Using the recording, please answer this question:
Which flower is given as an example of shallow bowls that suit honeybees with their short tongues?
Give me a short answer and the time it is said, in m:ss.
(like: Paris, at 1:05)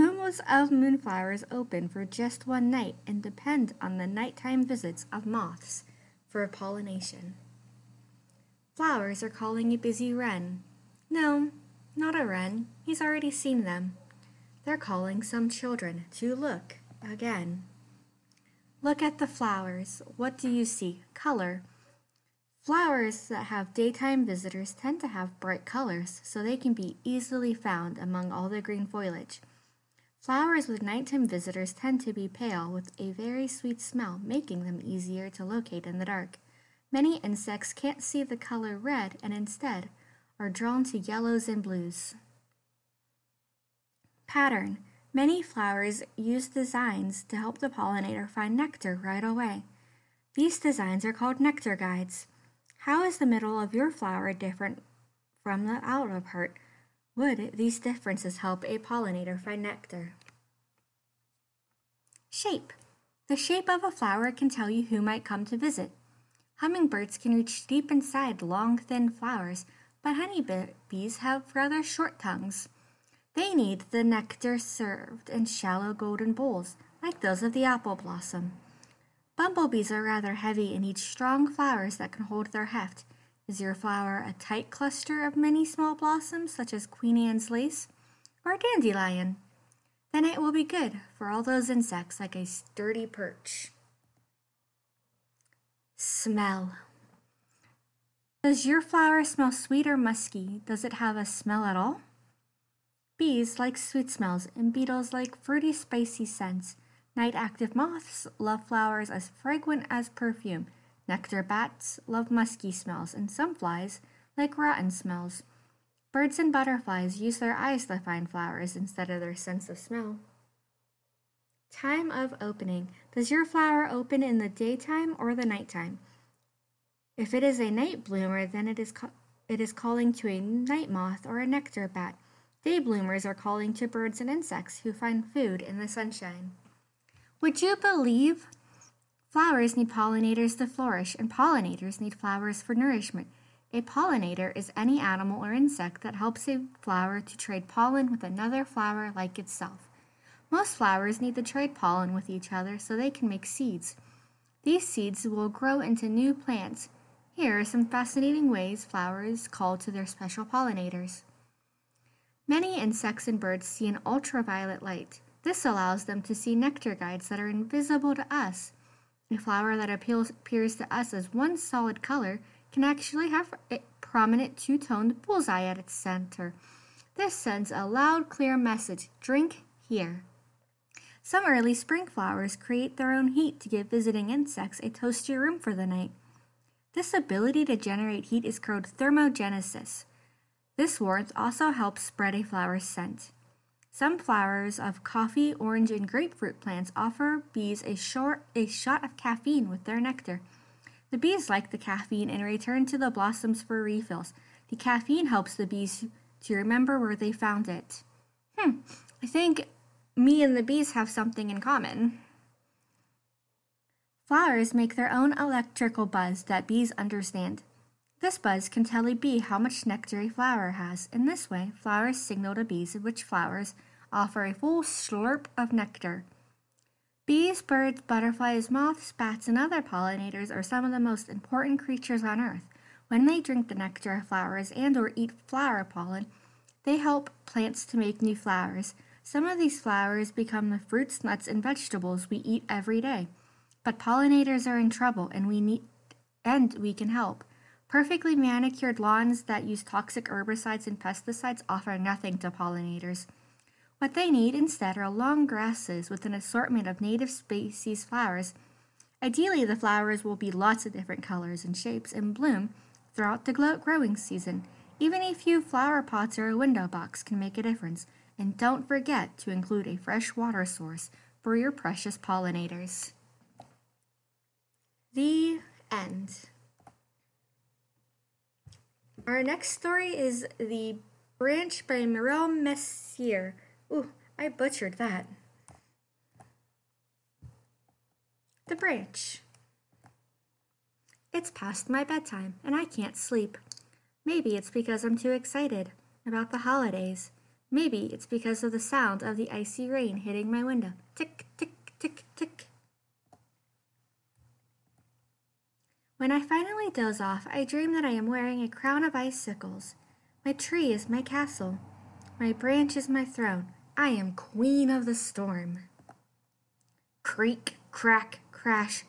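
Apple blossom, at 1:17.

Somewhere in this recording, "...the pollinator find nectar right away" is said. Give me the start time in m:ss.
0:47.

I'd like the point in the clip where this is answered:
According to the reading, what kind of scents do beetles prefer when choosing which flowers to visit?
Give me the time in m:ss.
1:45.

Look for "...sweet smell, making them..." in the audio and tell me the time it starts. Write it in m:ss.
0:33.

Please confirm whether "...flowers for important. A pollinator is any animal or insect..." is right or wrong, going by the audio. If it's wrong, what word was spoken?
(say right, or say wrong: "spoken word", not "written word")
wrong: "nourishment", not "important".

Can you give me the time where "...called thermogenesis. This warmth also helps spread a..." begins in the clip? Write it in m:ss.
3:08.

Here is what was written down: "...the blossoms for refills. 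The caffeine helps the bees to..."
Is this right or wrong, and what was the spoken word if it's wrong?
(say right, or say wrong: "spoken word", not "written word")
right.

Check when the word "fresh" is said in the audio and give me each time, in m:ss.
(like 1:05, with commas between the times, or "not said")
4:29.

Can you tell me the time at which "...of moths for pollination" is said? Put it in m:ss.
0:05.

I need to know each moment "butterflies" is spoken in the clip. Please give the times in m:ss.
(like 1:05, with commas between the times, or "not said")
1:56, 3:47.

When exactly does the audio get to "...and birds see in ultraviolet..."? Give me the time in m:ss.
2:43.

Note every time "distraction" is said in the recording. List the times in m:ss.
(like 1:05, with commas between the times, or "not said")
not said.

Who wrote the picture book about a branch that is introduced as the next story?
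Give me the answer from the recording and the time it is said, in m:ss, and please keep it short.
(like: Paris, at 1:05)
Mireille Messier, at 4:42.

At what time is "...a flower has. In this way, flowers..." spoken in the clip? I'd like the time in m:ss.
3:40.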